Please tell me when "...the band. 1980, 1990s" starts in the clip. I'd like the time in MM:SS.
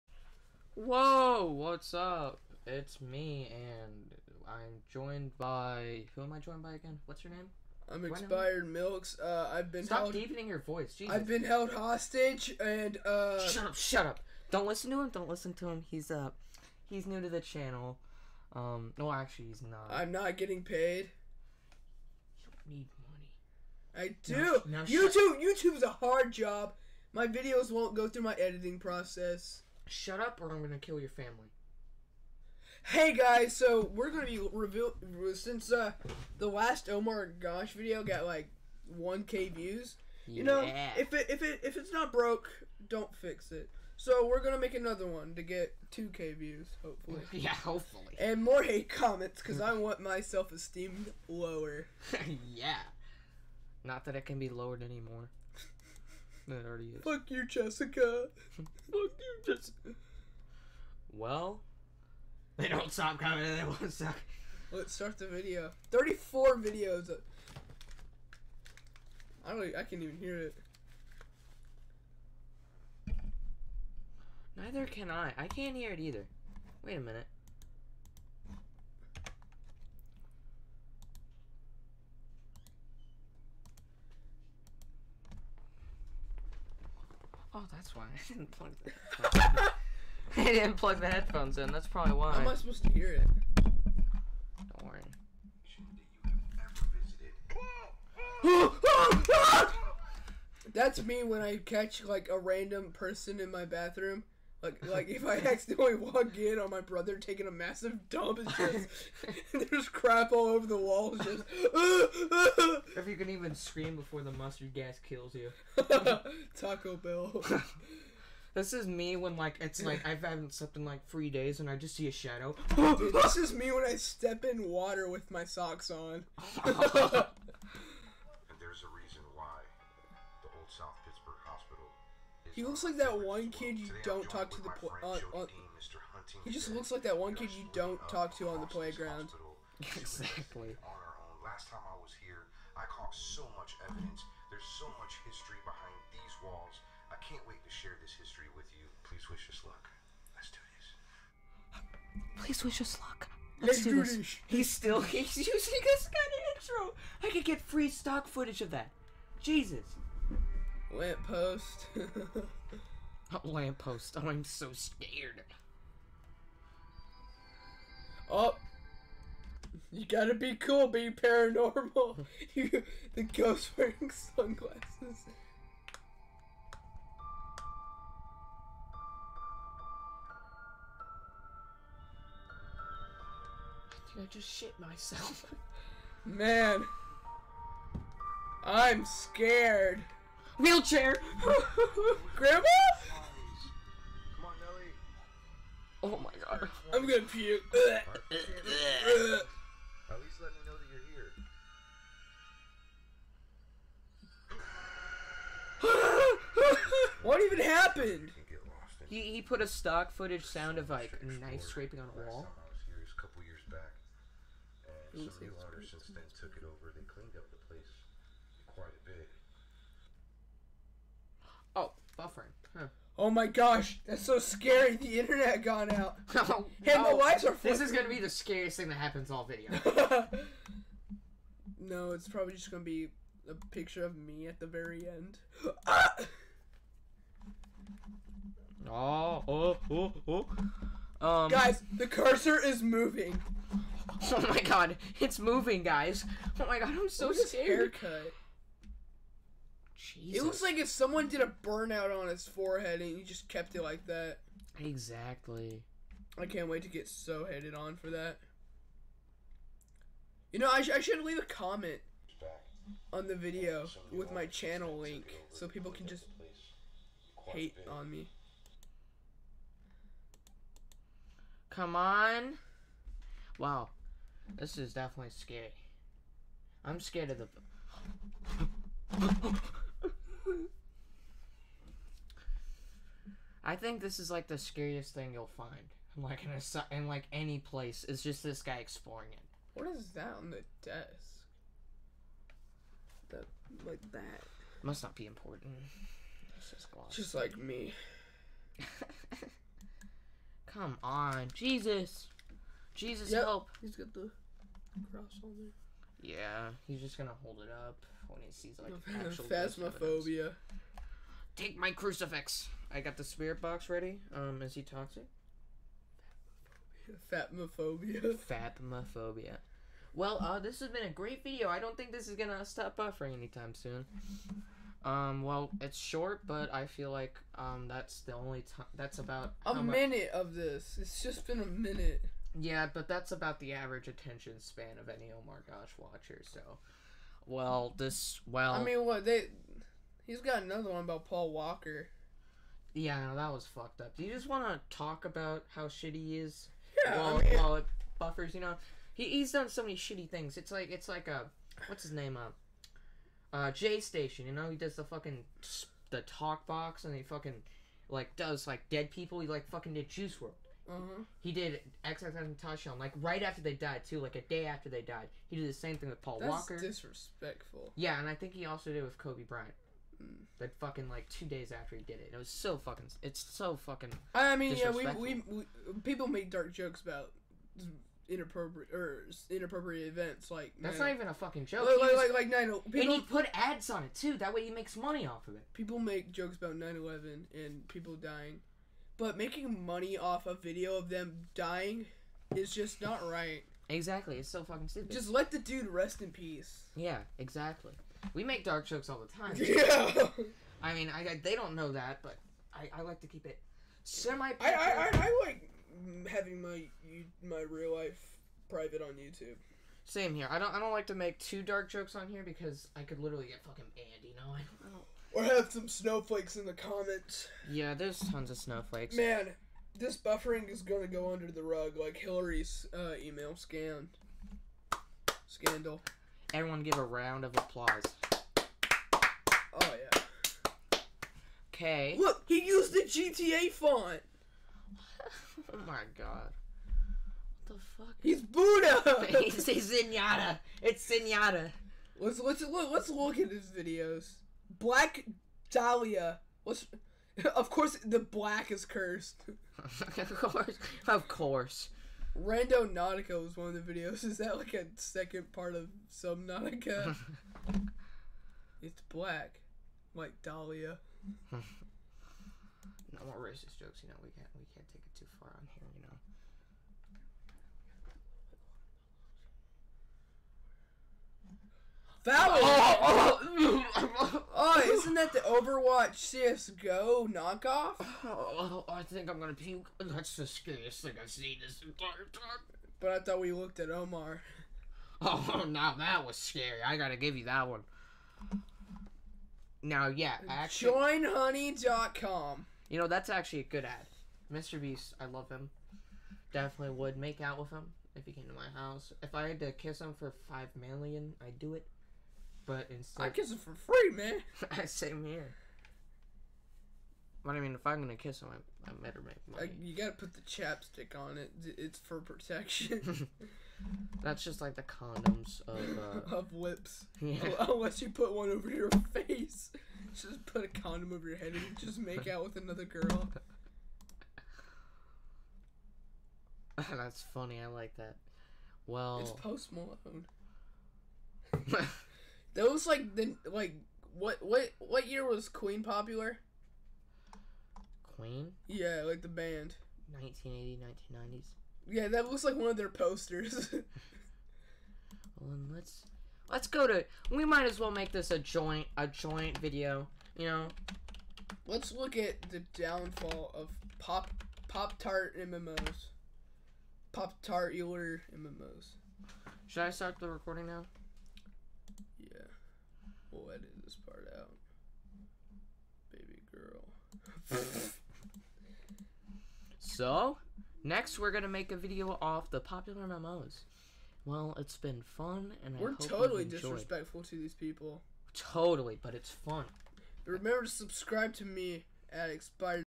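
08:59.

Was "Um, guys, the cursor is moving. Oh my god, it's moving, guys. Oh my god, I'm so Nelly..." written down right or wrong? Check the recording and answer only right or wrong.
wrong.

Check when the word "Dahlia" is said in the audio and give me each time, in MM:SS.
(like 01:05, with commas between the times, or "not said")
07:25, 07:40.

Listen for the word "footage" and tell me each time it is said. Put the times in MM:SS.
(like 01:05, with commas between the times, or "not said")
02:38, 03:30.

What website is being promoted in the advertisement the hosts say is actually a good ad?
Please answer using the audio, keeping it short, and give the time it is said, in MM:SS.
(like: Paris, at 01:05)
joinhoney.com, at 08:10.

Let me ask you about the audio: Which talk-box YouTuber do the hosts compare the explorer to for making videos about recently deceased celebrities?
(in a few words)
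Jay Station.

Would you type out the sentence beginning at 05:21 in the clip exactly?
I don't think this is gonna stop buffering anytime soon.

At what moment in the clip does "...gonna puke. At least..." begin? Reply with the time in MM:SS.
03:17.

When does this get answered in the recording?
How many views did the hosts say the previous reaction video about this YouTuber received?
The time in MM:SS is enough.
00:38.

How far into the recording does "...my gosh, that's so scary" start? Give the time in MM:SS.
03:43.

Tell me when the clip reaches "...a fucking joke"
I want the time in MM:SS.
06:21.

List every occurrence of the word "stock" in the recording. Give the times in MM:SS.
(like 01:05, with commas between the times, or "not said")
02:37, 03:29.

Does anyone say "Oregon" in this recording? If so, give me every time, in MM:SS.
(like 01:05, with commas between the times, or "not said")
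not said.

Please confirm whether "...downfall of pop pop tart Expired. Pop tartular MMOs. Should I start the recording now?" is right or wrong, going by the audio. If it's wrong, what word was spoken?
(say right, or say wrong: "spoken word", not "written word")
wrong: "MMOs", not "Expired".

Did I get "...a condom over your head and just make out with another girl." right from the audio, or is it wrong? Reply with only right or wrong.
right.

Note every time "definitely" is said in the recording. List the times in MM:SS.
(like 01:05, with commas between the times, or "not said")
04:34, 08:16.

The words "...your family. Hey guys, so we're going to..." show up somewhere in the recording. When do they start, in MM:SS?
00:31.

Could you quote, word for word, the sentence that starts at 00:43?
So we're gonna make another one to get 2k views, hopefully.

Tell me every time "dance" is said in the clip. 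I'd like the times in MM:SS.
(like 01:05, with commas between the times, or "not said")
not said.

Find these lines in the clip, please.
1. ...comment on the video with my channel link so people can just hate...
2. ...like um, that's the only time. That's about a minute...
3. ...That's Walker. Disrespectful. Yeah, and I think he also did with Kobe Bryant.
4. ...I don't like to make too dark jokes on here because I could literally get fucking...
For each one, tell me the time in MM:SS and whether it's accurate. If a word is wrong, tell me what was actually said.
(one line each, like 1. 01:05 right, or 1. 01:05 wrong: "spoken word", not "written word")
1. 04:21 right
2. 05:27 right
3. 06:06 right
4. 06:50 right.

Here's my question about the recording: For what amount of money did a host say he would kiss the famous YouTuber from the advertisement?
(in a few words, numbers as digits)
5 million.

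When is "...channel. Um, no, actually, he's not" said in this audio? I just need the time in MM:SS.
00:17.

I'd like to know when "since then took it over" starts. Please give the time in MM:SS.
03:35.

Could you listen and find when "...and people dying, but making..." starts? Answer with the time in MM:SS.
06:27.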